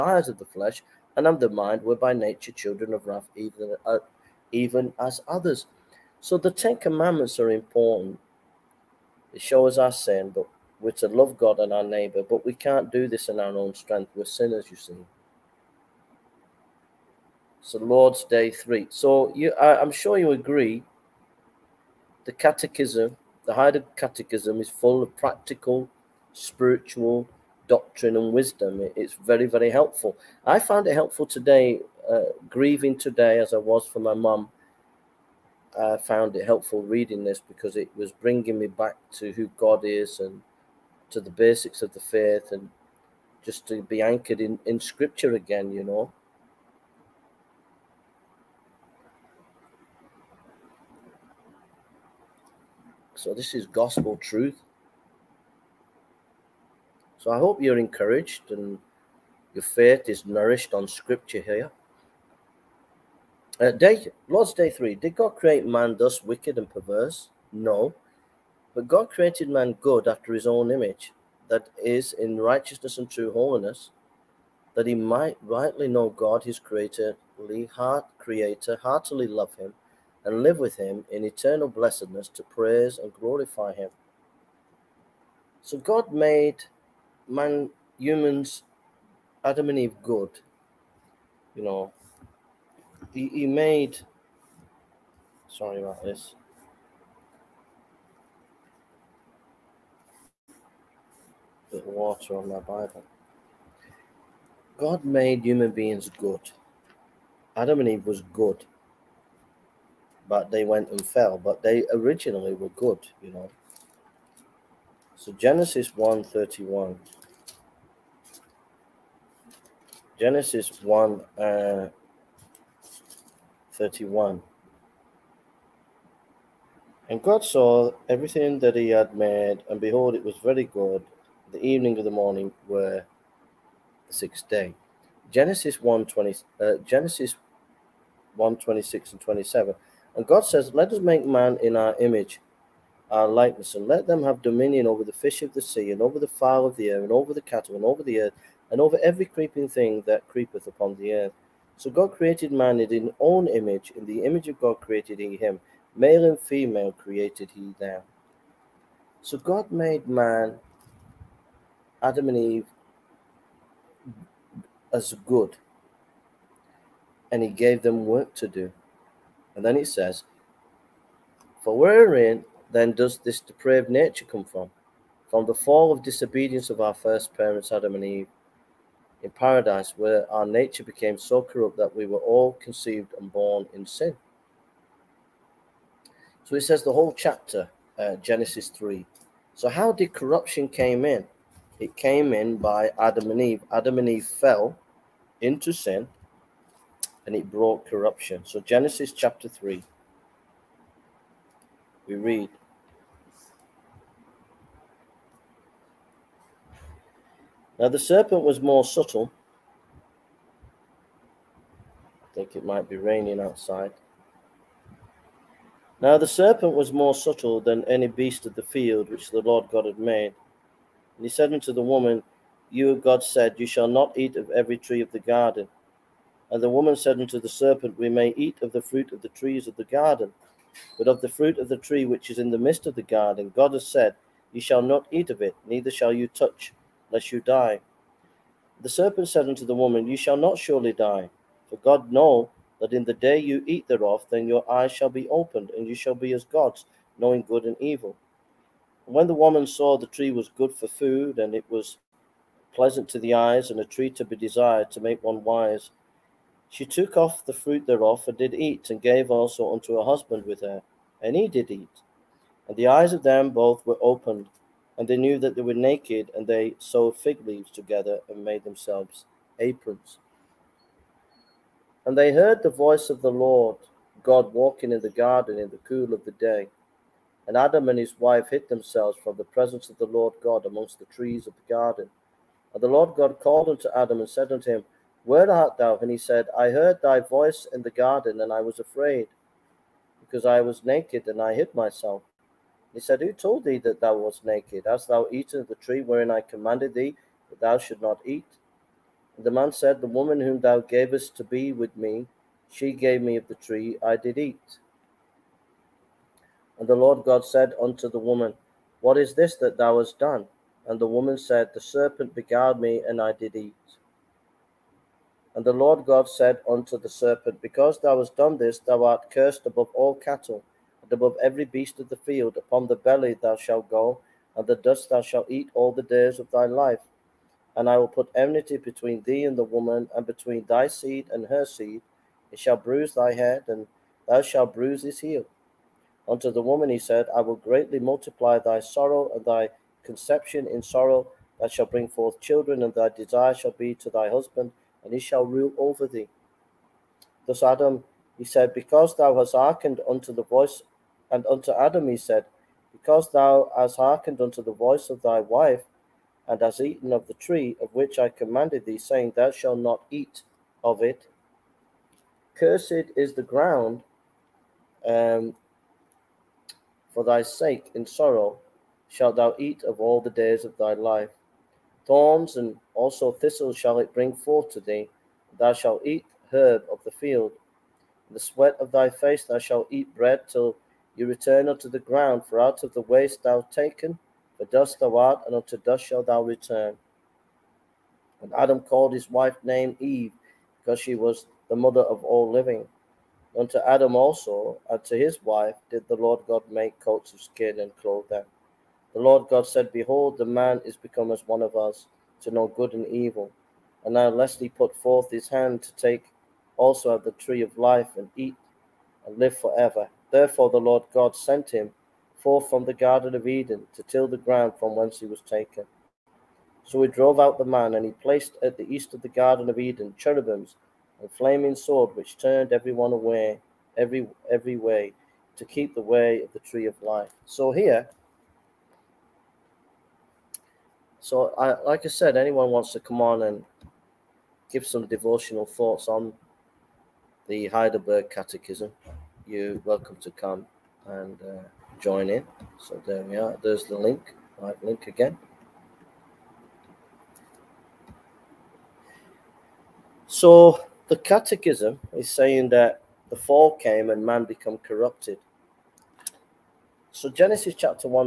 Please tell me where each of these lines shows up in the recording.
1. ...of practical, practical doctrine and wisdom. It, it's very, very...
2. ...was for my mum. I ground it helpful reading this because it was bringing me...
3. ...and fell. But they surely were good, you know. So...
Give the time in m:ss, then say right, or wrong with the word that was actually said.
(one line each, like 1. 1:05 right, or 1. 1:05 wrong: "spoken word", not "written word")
1. 0:25 wrong: "spiritual", not "practical"
2. 0:33 wrong: "found", not "ground"
3. 1:50 wrong: "originally", not "surely".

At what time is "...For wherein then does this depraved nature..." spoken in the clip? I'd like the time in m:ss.
2:51.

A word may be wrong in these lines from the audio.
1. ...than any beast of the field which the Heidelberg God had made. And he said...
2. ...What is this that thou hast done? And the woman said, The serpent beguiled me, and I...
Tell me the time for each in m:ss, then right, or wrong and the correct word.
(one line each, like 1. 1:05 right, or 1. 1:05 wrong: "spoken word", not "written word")
1. 3:37 wrong: "Lord", not "Heidelberg"
2. 5:09 right.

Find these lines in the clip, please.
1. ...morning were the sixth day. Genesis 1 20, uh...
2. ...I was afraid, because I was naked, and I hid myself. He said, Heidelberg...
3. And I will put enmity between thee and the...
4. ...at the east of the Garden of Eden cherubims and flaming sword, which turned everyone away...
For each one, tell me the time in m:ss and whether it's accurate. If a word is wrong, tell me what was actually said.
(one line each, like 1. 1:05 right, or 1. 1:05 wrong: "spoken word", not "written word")
1. 2:12 right
2. 4:48 wrong: "Who", not "Heidelberg"
3. 5:27 right
4. 6:58 right.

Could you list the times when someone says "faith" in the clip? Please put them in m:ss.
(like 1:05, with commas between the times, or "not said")
0:42, 0:59.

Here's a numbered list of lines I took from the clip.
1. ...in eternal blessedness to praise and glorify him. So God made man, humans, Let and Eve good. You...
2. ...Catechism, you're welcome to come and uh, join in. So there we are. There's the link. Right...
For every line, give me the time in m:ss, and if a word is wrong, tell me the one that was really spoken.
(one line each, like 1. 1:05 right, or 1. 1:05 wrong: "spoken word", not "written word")
1. 1:21 wrong: "Adam", not "Let"
2. 7:18 right.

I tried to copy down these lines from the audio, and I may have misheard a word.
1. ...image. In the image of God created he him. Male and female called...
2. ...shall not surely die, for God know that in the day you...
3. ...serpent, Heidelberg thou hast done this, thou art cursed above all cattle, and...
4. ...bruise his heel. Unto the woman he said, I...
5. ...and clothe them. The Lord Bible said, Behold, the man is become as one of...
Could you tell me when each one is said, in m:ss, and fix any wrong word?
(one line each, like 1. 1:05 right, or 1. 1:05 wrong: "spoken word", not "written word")
1. 2:33 wrong: "created", not "called"
2. 4:00 right
3. 5:17 wrong: "Because", not "Heidelberg"
4. 5:34 right
5. 6:37 wrong: "God", not "Bible".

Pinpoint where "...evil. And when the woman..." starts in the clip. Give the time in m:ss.
4:07.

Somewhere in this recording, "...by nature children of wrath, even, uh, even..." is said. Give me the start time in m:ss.
0:01.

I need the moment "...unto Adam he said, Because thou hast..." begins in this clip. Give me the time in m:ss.
5:51.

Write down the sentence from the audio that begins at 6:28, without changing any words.
And Adam called his wife name Eve, because she was the mother of all living.